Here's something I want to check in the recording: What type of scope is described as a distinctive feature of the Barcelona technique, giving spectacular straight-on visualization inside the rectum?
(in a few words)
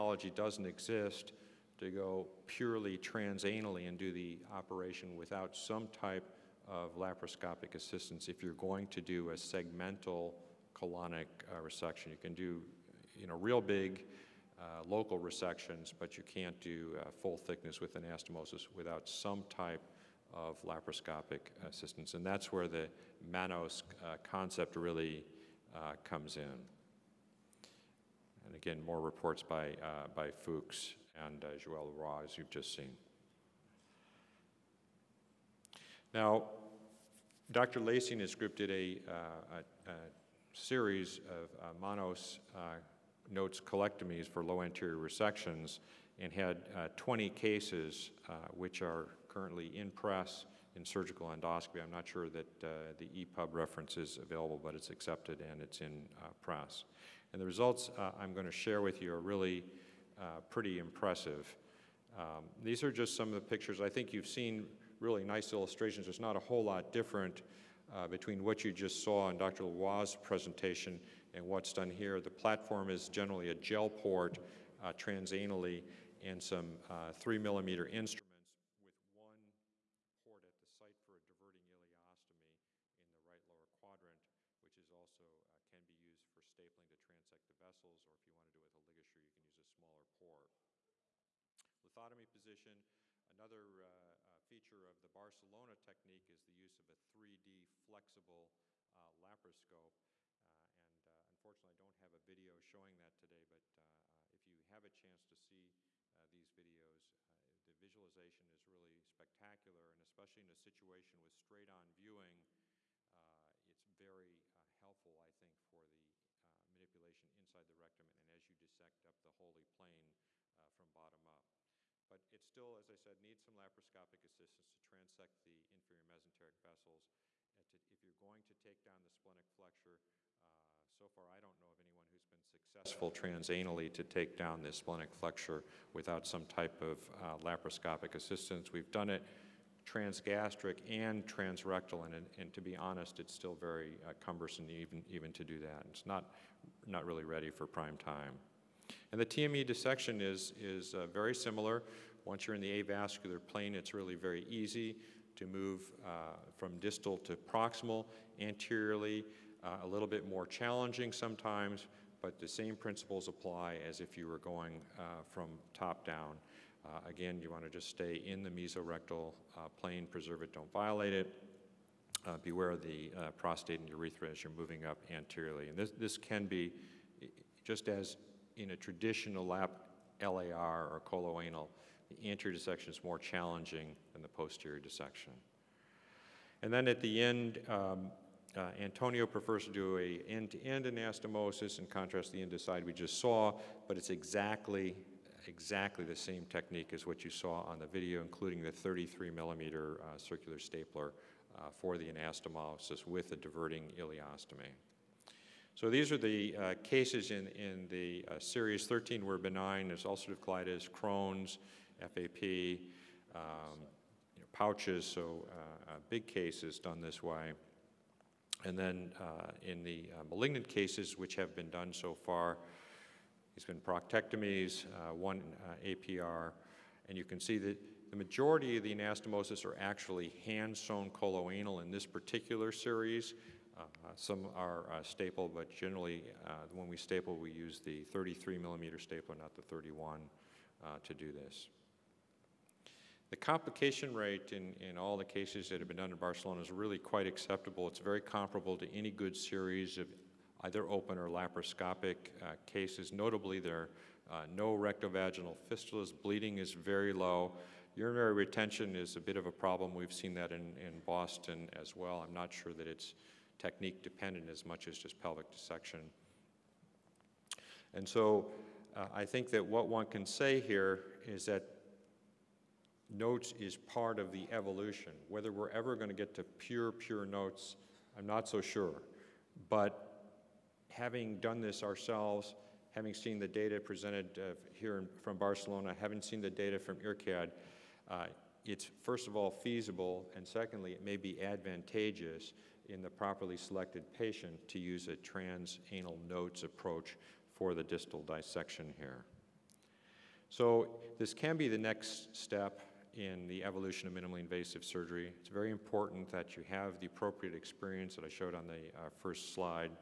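3D flexible laparoscope.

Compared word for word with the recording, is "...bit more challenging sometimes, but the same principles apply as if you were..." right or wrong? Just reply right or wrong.
right.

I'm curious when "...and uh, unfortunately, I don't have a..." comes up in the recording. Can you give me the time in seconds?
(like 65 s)
100 s.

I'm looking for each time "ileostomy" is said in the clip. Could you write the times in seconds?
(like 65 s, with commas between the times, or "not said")
81 s, 203 s.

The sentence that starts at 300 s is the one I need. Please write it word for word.
So this can be the next step in the evolution of minimally invasive surgery.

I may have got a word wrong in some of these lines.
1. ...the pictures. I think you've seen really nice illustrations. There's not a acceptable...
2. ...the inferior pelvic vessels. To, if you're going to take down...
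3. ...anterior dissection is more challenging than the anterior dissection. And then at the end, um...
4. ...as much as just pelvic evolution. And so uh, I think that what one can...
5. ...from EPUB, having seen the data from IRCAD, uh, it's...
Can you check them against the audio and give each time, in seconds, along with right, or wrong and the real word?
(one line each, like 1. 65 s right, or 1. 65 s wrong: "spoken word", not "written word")
1. 63 s wrong: "whole", not "acceptable"
2. 125 s wrong: "mesenteric", not "pelvic"
3. 182 s wrong: "posterior", not "anterior"
4. 264 s wrong: "dissection", not "evolution"
5. 285 s wrong: "Barcelona", not "EPUB".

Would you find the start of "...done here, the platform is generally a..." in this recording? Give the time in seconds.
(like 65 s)
71 s.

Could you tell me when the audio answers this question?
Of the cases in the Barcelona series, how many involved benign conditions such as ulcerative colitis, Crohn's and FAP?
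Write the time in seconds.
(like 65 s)
208 s.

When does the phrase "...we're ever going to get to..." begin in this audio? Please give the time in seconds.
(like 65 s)
275 s.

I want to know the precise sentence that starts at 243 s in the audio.
The complication rate in, in all the cases that have been done in Barcelona is really quite acceptable.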